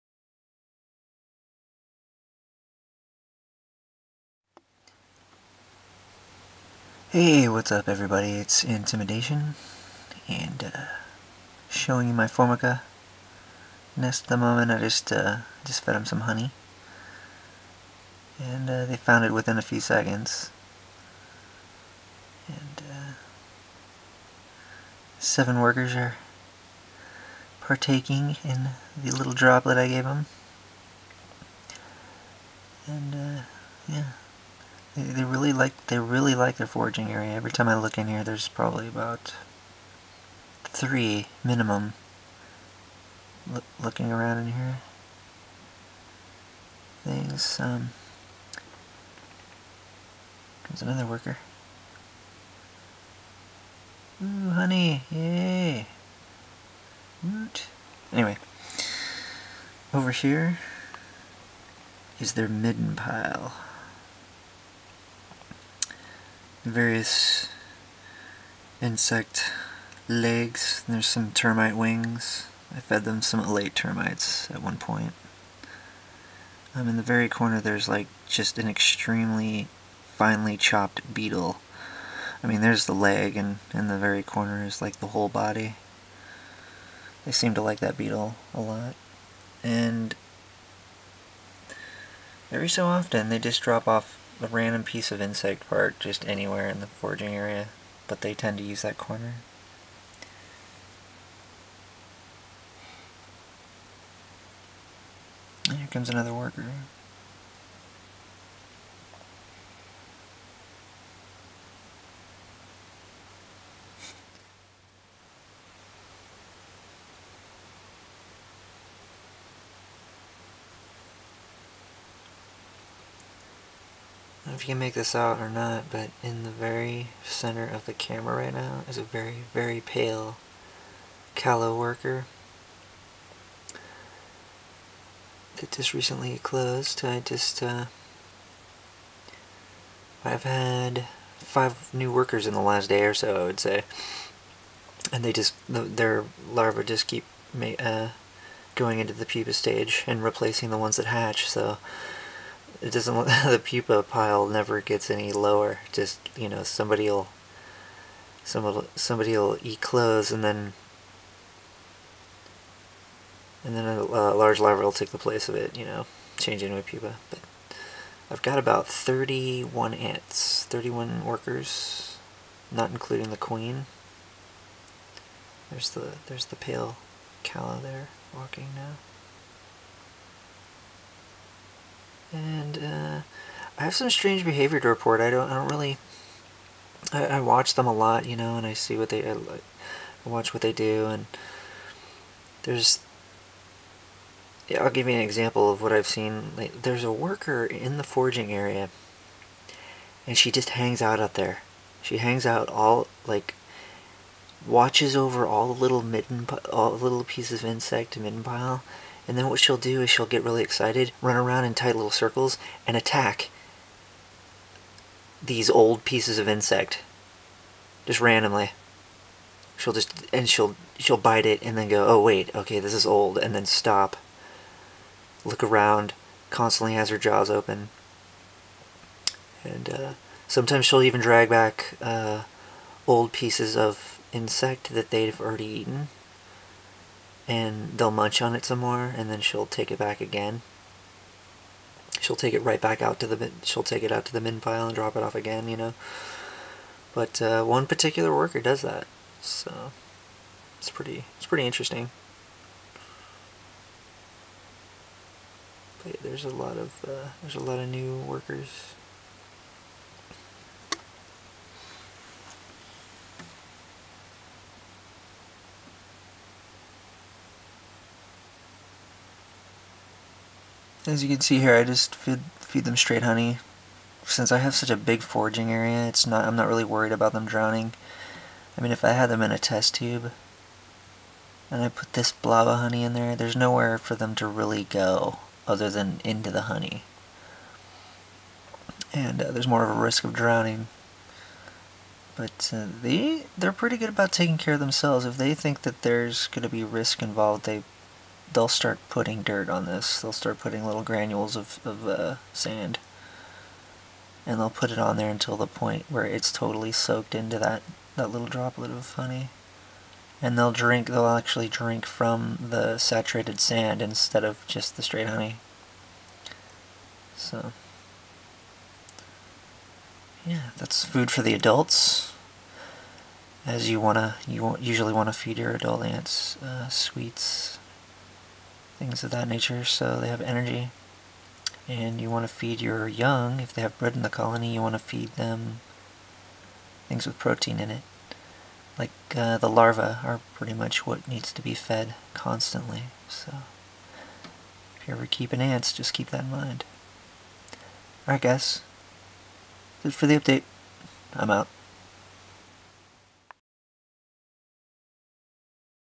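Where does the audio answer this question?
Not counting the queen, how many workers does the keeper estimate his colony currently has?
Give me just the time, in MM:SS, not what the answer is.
02:50.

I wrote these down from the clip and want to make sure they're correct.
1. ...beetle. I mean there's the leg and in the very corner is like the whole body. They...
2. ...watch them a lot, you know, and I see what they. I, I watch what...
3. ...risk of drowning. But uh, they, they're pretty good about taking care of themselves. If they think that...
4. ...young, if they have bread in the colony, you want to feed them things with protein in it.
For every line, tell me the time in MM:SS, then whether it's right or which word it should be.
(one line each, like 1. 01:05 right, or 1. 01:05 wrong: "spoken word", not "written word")
1. 01:21 right
2. 03:07 right
3. 04:49 right
4. 05:33 right.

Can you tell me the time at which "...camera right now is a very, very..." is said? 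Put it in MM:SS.
02:07.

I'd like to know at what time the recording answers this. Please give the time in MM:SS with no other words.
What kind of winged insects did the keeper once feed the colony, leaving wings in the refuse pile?
01:13.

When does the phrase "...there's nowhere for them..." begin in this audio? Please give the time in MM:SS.
04:43.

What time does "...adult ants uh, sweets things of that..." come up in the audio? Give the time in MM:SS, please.
05:25.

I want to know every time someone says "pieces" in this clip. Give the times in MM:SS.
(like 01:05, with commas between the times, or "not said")
01:34, 03:27, 03:36, 03:53.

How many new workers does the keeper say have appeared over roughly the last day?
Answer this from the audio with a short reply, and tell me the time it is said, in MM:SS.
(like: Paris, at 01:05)
5, at 02:21.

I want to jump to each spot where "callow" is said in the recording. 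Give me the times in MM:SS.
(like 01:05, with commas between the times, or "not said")
02:11, 02:57.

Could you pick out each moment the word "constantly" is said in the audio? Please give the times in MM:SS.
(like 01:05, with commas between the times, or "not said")
03:46, 05:42.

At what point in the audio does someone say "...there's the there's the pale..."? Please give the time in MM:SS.
02:55.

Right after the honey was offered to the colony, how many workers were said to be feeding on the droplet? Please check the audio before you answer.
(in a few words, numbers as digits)
7.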